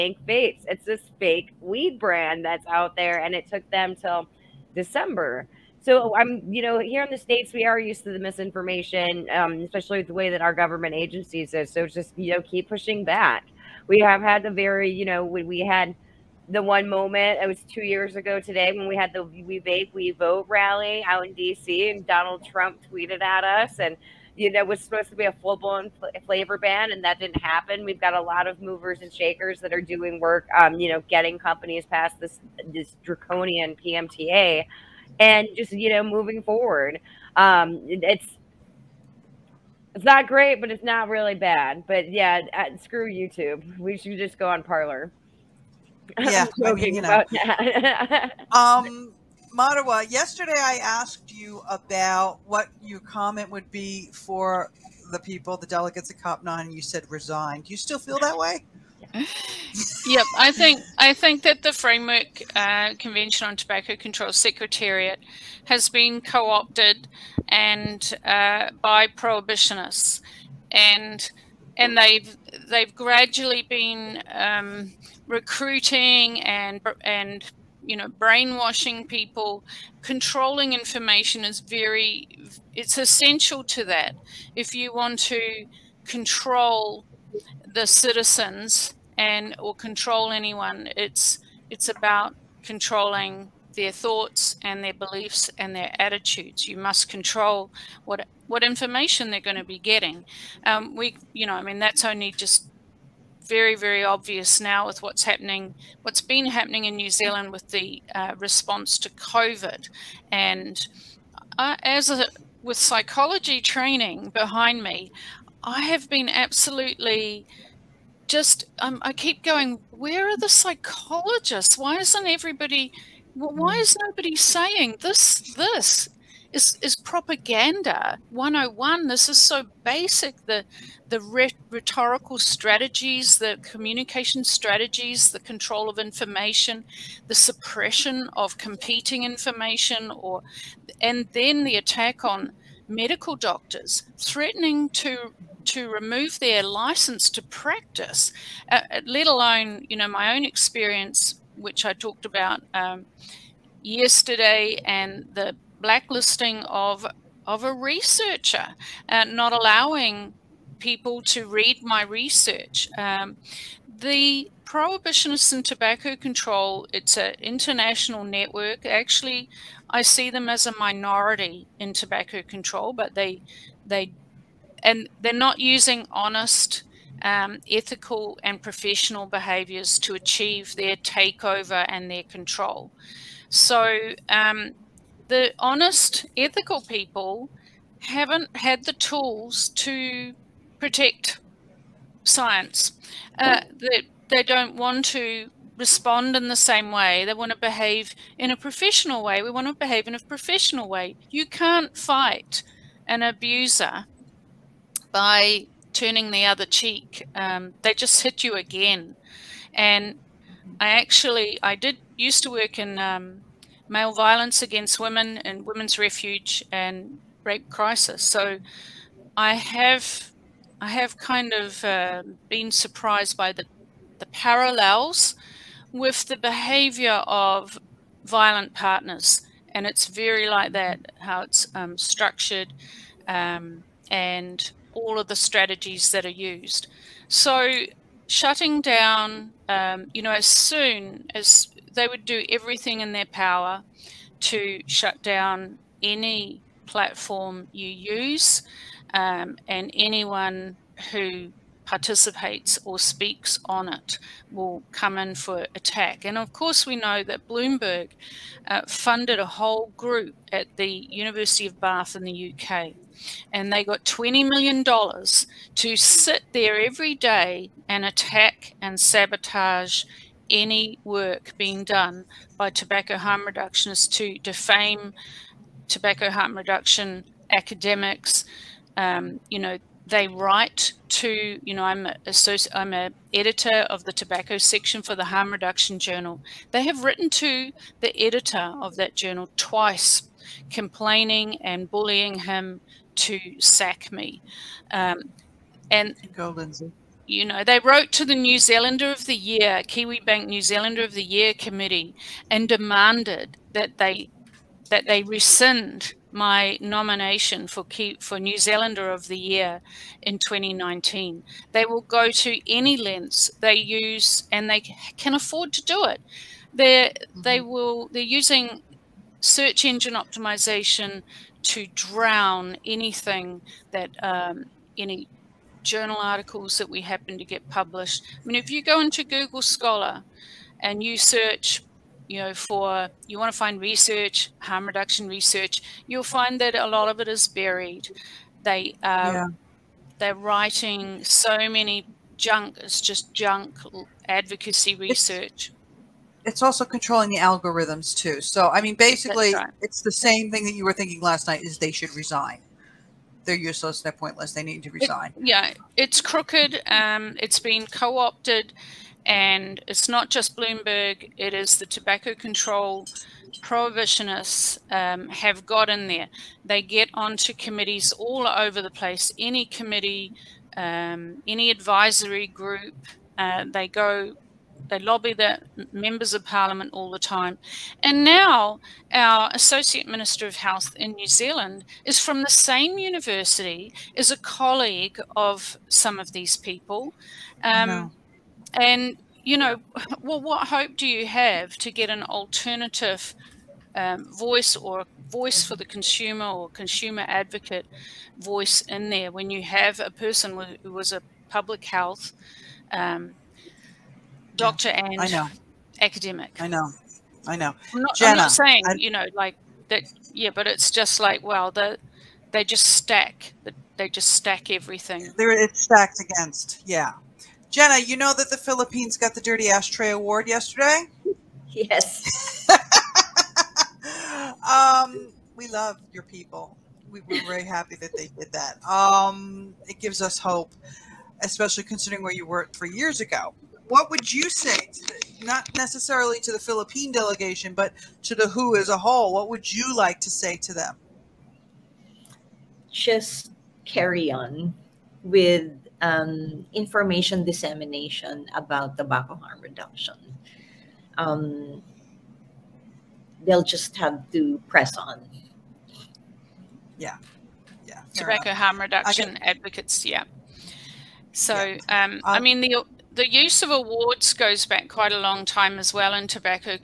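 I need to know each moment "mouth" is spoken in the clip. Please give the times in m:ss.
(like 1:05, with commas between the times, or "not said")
not said.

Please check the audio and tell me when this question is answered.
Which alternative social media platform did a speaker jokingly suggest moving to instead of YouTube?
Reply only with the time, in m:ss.
0:44.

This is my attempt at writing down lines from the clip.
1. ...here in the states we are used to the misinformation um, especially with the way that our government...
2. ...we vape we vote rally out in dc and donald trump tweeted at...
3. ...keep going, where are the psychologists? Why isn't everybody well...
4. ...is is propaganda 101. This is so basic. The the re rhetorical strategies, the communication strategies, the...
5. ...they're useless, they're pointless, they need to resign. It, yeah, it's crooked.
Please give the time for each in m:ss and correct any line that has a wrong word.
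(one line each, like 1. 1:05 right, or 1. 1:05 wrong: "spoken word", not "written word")
1. 0:06 right
2. 0:19 right
3. 1:59 right
4. 2:06 right
5. 5:53 right.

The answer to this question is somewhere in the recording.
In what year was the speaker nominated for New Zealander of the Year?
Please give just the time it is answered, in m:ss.
5:10.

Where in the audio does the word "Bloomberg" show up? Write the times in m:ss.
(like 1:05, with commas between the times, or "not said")
4:17, 6:00.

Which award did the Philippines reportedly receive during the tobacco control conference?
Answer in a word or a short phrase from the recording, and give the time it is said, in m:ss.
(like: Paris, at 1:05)
Dirty Ashtray Award, at 6:59.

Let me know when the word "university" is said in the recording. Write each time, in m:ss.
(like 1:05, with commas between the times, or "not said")
4:20, 6:22.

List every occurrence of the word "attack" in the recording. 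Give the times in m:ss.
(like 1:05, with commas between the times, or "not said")
2:21, 4:15, 4:28.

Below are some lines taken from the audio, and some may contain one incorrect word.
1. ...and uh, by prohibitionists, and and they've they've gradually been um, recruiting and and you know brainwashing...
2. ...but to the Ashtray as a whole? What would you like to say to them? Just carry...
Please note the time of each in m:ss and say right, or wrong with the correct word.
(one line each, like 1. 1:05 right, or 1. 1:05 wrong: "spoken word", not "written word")
1. 1:07 right
2. 7:17 wrong: "WHO", not "Ashtray".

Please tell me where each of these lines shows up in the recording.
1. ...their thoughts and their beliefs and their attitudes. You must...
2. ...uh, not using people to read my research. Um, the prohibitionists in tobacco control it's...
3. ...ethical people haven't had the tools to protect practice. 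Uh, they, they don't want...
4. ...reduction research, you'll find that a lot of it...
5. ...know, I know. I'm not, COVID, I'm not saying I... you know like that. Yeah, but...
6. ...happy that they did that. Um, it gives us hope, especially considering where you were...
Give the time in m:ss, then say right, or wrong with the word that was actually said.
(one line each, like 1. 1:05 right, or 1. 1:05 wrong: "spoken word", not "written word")
1. 1:33 right
2. 2:39 wrong: "allowing", not "using"
3. 3:06 wrong: "science", not "practice"
4. 5:34 right
5. 6:46 wrong: "Jena", not "COVID"
6. 7:07 right.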